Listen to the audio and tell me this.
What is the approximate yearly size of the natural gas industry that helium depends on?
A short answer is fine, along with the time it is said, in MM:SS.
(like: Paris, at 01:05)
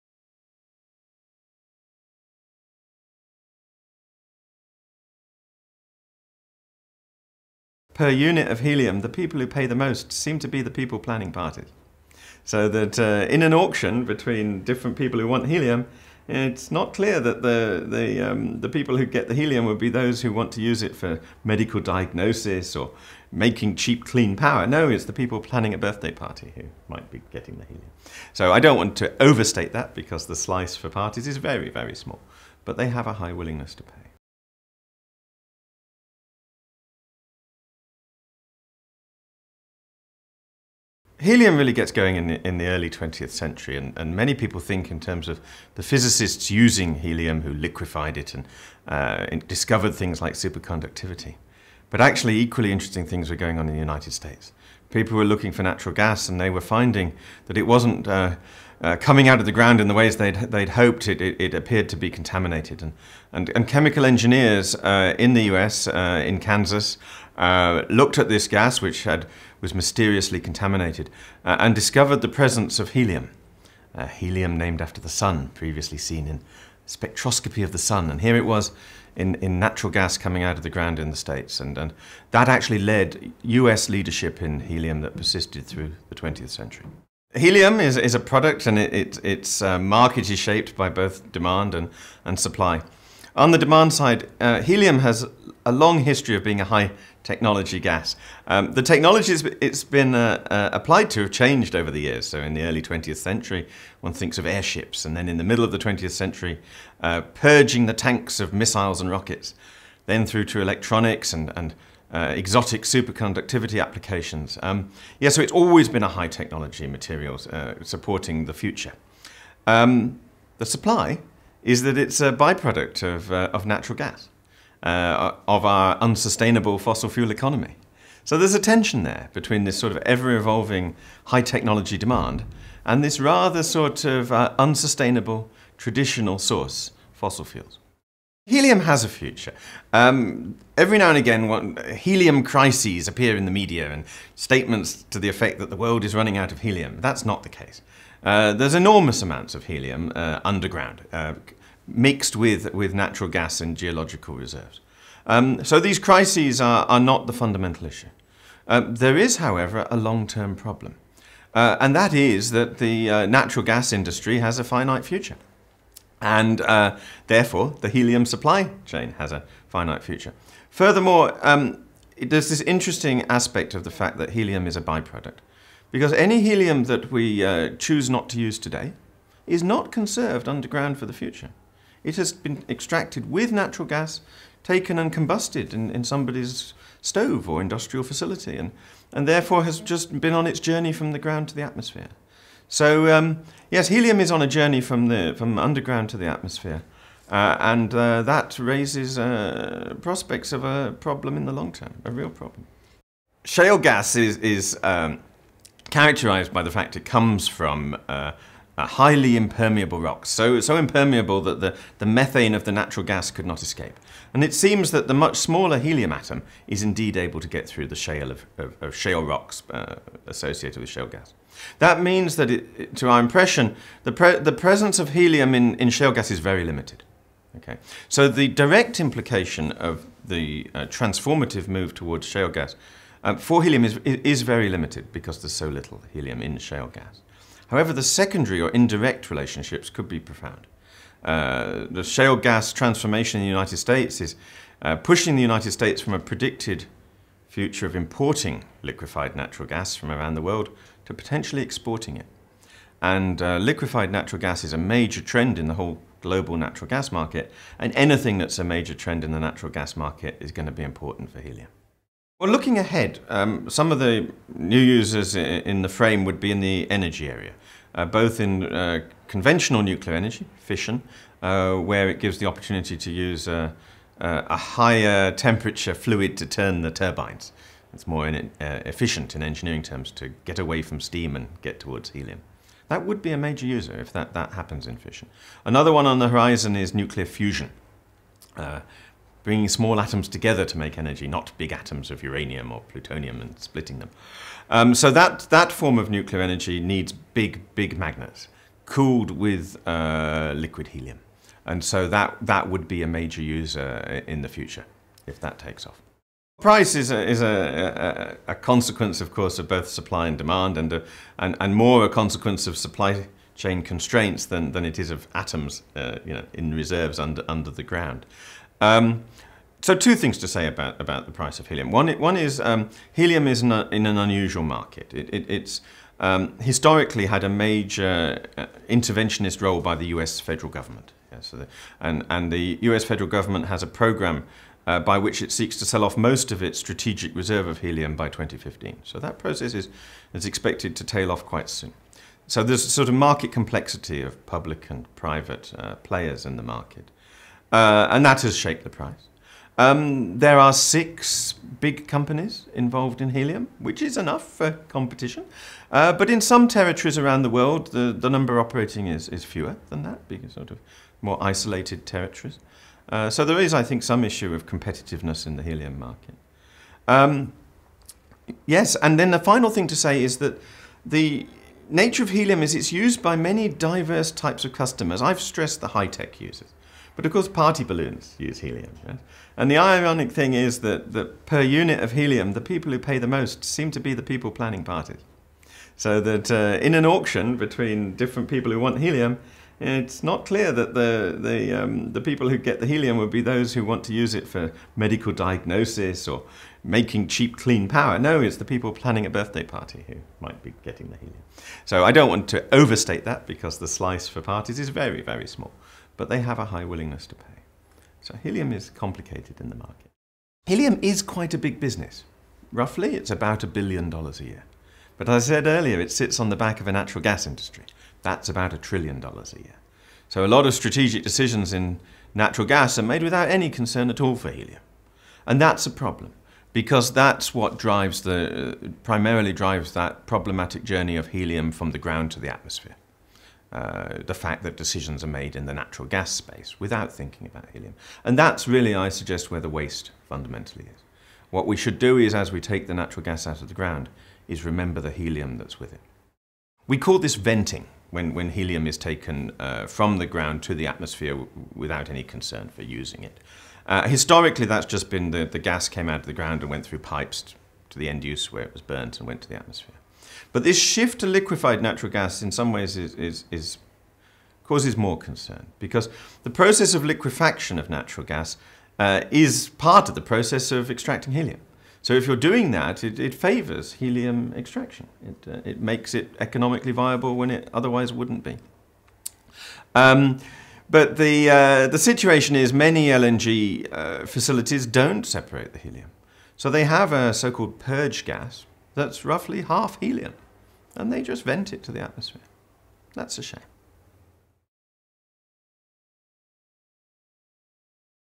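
$1 trillion, at 06:58.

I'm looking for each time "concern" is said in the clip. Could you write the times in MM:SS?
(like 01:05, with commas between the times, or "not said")
07:03, 07:32, 07:45.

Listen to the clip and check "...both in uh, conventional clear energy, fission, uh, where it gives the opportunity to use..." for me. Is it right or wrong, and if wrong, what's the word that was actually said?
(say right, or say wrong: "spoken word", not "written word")
wrong: "nuclear", not "clear".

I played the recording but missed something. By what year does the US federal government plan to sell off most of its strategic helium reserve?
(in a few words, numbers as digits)
2015.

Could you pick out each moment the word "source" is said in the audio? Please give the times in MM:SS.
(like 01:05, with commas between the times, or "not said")
02:16.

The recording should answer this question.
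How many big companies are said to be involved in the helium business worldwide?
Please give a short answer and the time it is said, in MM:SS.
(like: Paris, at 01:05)
6, at 05:50.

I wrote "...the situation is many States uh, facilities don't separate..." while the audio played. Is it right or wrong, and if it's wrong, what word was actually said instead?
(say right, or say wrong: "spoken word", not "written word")
wrong: "LNG", not "States".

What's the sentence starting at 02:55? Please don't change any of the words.
Because any helium that we uh, choose not to use today is not conserved underground for the future.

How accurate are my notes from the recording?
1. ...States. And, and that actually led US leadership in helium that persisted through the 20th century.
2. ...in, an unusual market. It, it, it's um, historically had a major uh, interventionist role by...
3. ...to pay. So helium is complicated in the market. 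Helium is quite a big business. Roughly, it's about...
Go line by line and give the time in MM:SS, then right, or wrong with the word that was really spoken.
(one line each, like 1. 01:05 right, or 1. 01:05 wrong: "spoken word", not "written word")
1. 01:21 right
2. 05:23 right
3. 06:47 right.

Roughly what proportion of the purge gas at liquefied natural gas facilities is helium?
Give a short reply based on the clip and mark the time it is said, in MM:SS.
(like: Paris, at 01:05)
half, at 08:09.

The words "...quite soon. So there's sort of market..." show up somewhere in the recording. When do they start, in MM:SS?
05:41.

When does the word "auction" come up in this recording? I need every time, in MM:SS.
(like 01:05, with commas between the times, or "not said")
00:13, 06:27.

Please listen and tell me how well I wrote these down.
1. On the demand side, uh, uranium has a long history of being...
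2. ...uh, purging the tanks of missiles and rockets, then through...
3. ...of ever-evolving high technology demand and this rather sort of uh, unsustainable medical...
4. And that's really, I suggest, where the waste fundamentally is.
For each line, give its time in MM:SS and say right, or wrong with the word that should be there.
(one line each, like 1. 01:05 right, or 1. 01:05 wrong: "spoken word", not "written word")
1. 01:33 wrong: "helium", not "uranium"
2. 01:47 right
3. 02:09 wrong: "traditional", not "medical"
4. 07:18 right.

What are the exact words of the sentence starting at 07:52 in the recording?
So if you're doing that, it, it favors helium extraction.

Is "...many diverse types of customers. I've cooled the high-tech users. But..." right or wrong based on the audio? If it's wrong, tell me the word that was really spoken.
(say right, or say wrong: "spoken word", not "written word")
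wrong: "stressed", not "cooled".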